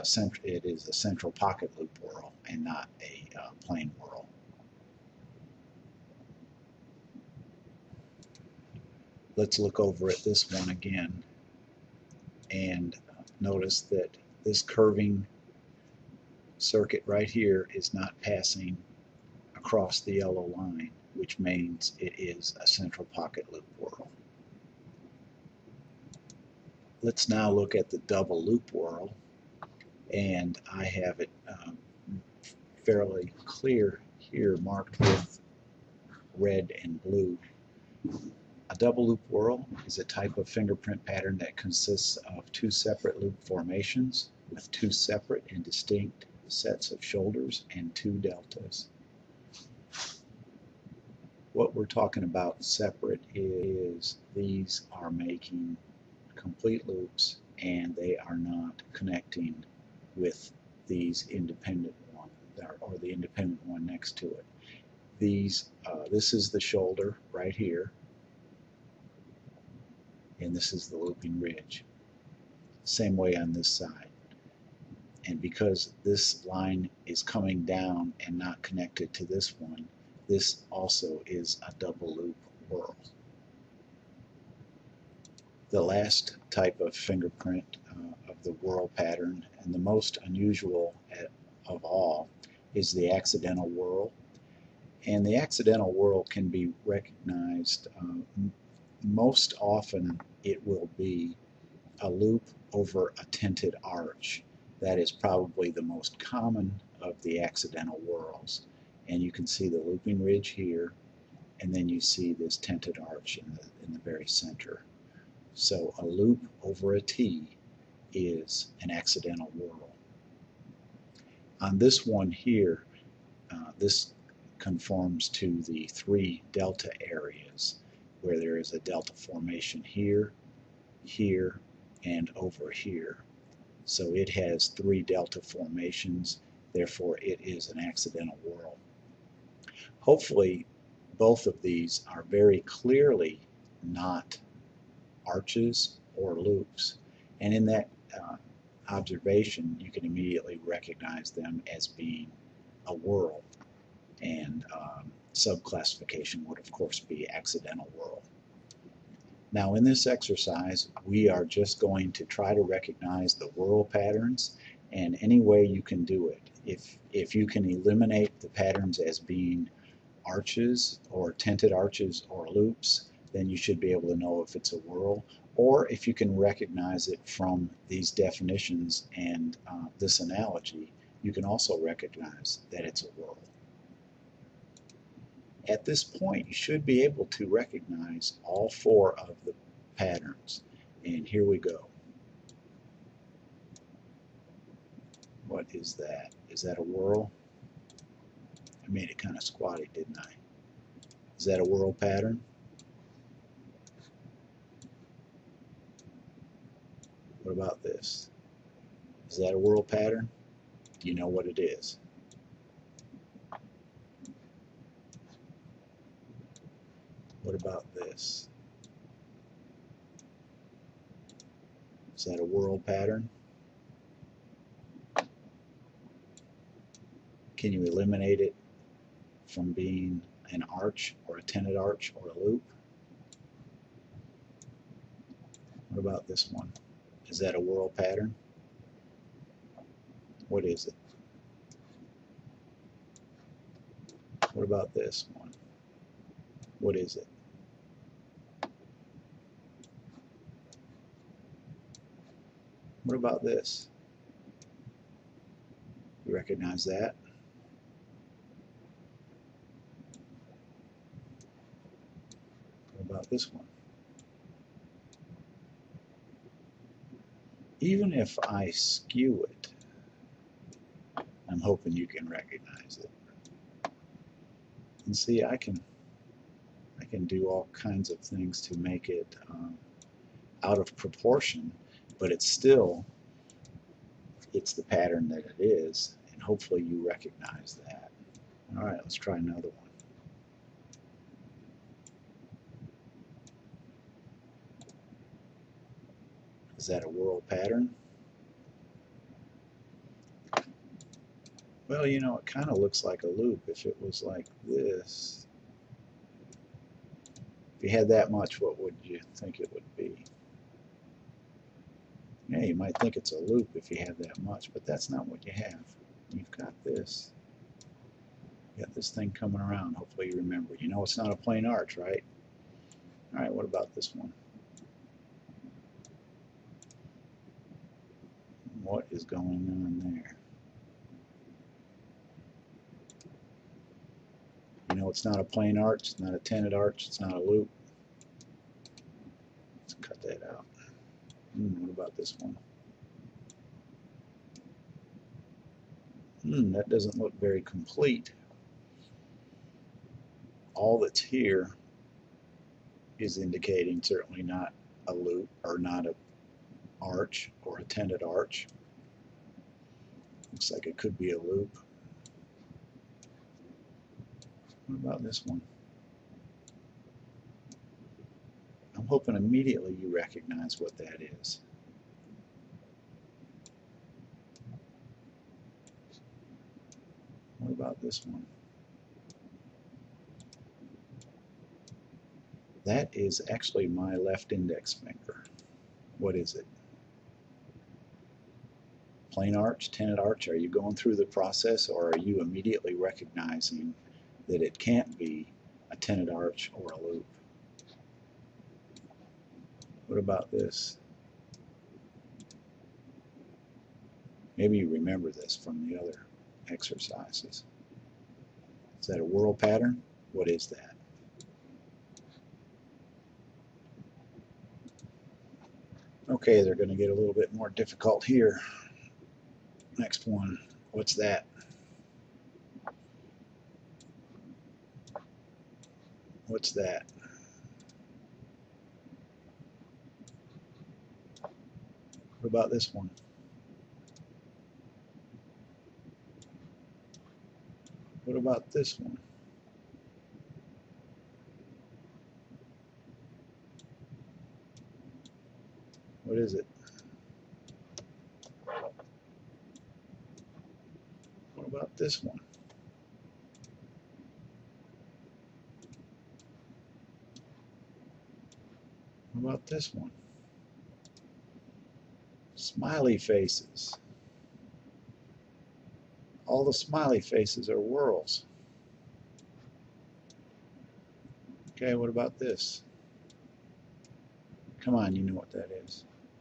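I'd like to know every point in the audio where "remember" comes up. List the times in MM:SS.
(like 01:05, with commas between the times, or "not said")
05:20, 06:44.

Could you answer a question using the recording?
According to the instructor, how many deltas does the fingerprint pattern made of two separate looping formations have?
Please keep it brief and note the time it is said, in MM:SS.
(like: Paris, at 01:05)
2, at 00:47.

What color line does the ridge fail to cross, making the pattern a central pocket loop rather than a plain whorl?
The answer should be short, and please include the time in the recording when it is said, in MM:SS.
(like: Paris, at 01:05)
Yellow, at 00:20.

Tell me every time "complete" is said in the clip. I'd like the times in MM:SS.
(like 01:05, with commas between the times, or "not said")
00:56, 05:47.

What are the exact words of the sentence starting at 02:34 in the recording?
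And um, subclassification would of course be accidental whorl.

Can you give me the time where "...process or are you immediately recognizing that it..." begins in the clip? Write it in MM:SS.
06:31.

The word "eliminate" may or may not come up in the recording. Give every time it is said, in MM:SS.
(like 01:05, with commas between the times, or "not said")
02:47, 03:47.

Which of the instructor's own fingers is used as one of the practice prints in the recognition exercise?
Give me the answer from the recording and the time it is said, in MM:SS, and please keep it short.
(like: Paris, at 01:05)
Left index finger, at 06:24.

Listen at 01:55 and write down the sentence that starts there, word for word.
So a loop over a T is an accidental whorl.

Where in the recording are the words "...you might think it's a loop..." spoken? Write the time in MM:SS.
05:12.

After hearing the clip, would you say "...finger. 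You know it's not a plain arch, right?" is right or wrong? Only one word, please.
wrong.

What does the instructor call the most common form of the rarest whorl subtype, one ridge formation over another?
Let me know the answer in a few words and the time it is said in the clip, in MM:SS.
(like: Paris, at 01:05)
A loop over a tented arch, at 01:42.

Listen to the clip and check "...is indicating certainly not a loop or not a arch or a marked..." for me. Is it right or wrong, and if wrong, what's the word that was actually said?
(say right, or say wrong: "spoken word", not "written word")
wrong: "tented", not "marked".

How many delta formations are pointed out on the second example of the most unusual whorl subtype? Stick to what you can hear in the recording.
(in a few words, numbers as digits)
3.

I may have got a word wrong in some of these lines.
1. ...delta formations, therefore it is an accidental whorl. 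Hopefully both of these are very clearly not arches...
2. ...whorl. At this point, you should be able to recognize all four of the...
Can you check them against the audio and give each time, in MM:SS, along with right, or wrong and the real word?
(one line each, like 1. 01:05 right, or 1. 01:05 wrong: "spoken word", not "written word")
1. 02:15 right
2. 03:03 right.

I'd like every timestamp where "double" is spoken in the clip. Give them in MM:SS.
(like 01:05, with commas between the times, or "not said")
00:27, 00:38, 01:21.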